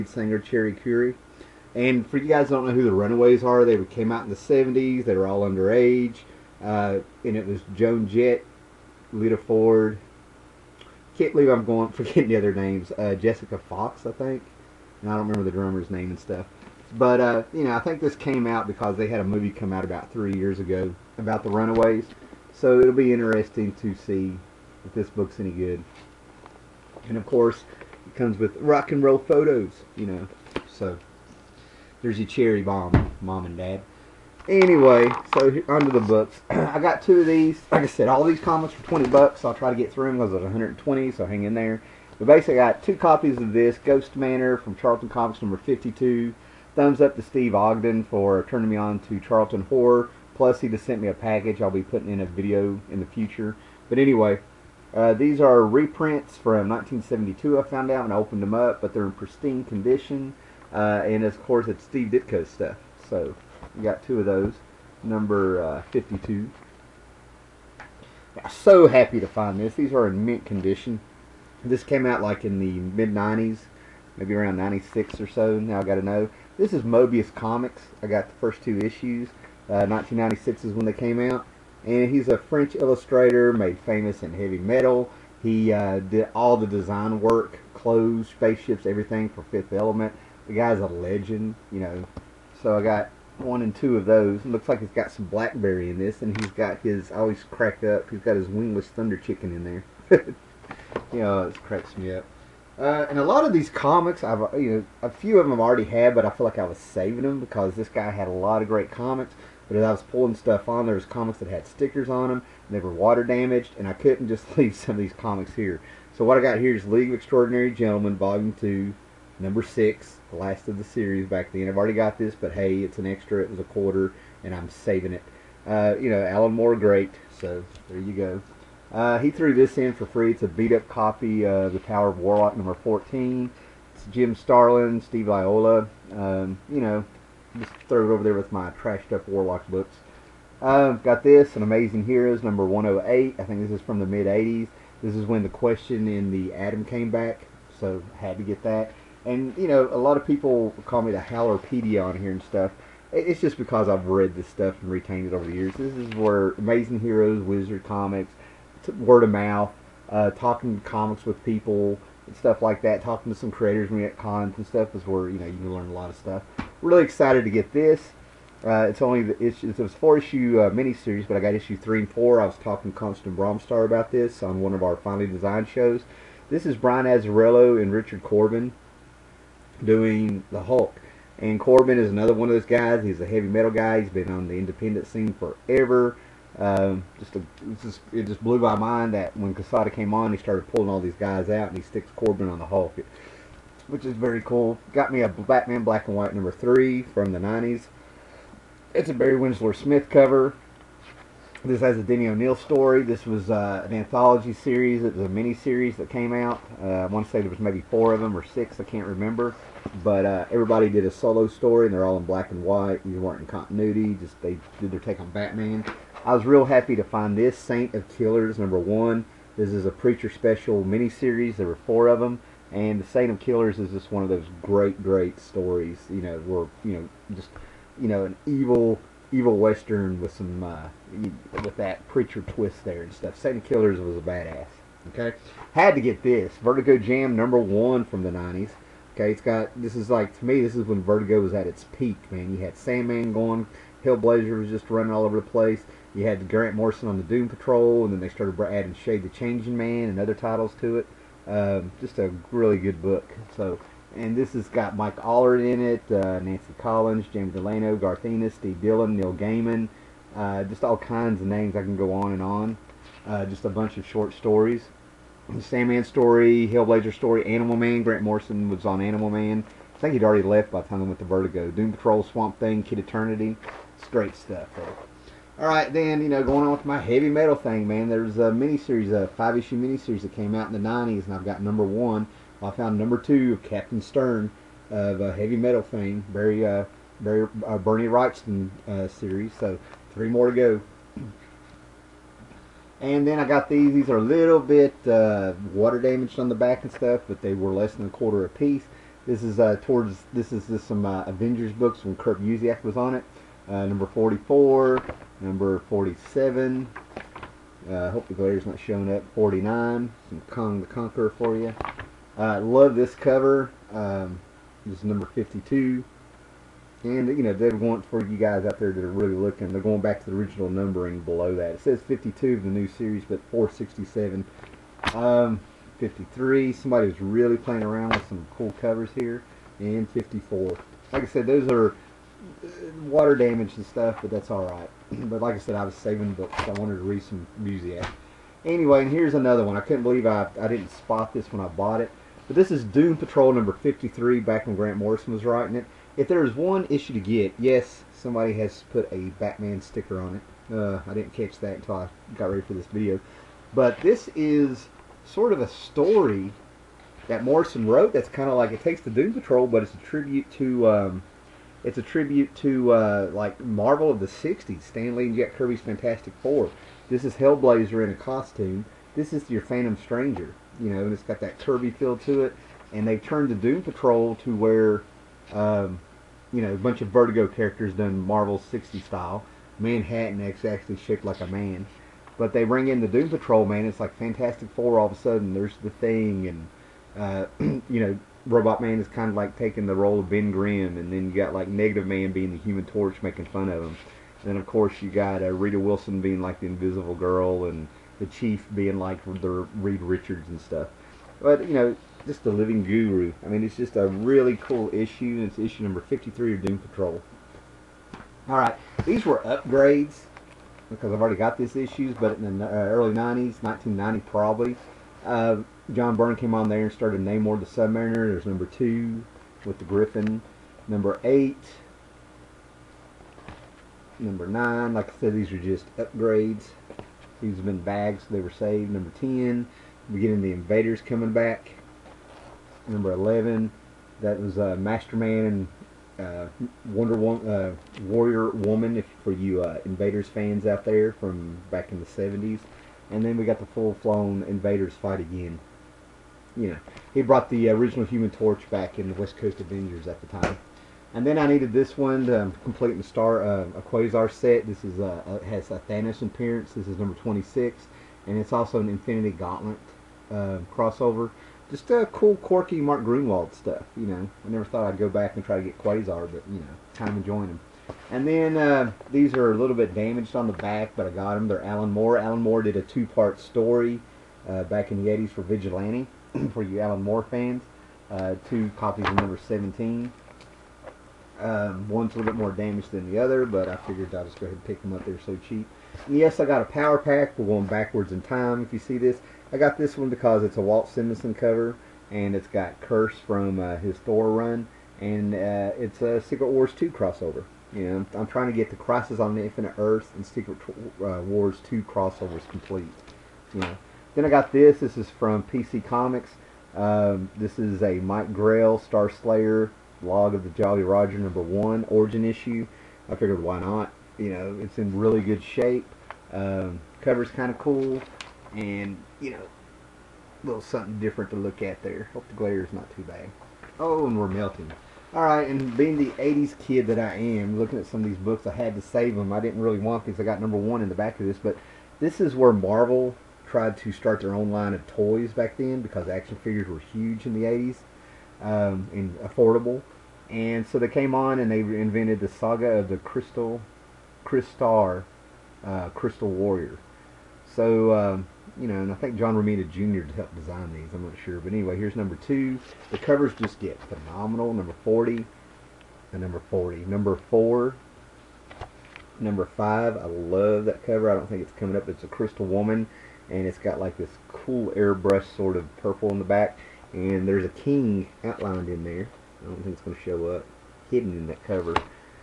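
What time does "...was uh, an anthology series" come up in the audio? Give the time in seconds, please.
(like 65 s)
203 s.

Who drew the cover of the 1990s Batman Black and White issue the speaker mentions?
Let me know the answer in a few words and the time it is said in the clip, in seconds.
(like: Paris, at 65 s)
Barry Windsor-Smith, at 199 s.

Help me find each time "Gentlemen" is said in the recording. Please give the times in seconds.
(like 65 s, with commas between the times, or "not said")
117 s.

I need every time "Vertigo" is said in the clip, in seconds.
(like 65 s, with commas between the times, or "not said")
236 s, 241 s, 271 s, 377 s.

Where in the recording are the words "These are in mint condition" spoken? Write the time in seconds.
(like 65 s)
69 s.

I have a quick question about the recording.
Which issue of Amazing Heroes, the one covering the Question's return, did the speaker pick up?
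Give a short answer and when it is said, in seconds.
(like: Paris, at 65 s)
108, at 142 s.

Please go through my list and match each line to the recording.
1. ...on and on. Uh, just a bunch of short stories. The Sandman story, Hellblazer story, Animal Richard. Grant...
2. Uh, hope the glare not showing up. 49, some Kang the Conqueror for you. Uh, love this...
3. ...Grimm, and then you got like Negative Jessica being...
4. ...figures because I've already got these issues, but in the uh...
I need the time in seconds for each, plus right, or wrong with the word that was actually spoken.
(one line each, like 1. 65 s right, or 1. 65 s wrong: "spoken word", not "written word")
1. 262 s wrong: "Man", not "Richard"
2. 307 s right
3. 390 s wrong: "Man", not "Jessica"
4. 409 s wrong: "upgrades", not "figures".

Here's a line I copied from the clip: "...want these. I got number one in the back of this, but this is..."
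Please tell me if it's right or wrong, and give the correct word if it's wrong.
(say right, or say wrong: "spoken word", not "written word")
right.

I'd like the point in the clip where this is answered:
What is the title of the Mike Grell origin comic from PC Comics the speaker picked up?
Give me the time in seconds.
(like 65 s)
508 s.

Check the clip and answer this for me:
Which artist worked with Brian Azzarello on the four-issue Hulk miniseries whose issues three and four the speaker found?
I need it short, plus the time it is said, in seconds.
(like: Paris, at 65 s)
Richard Corbin, at 177 s.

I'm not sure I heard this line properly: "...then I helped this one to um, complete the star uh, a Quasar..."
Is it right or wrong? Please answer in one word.
wrong.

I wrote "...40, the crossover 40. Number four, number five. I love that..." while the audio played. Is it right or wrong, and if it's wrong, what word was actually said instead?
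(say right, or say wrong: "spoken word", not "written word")
wrong: "number", not "crossover".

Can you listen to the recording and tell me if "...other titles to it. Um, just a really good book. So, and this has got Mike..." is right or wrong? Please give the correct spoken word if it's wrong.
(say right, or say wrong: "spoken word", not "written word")
right.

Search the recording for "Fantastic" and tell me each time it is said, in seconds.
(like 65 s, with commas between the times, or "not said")
365 s, 384 s.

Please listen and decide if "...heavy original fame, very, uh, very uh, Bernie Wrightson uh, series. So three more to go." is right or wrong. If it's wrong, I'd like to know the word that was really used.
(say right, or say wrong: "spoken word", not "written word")
wrong: "metal", not "original".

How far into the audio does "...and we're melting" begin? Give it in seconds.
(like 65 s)
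524 s.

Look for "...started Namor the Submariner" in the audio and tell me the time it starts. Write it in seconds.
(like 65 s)
416 s.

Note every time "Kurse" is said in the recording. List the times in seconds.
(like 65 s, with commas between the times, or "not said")
492 s.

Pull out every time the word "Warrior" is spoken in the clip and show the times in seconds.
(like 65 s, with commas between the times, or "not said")
438 s, 546 s.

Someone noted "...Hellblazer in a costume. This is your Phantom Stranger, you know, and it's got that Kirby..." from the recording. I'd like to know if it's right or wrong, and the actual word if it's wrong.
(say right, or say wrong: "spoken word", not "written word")
right.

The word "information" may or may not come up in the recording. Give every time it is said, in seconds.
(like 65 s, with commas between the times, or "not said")
not said.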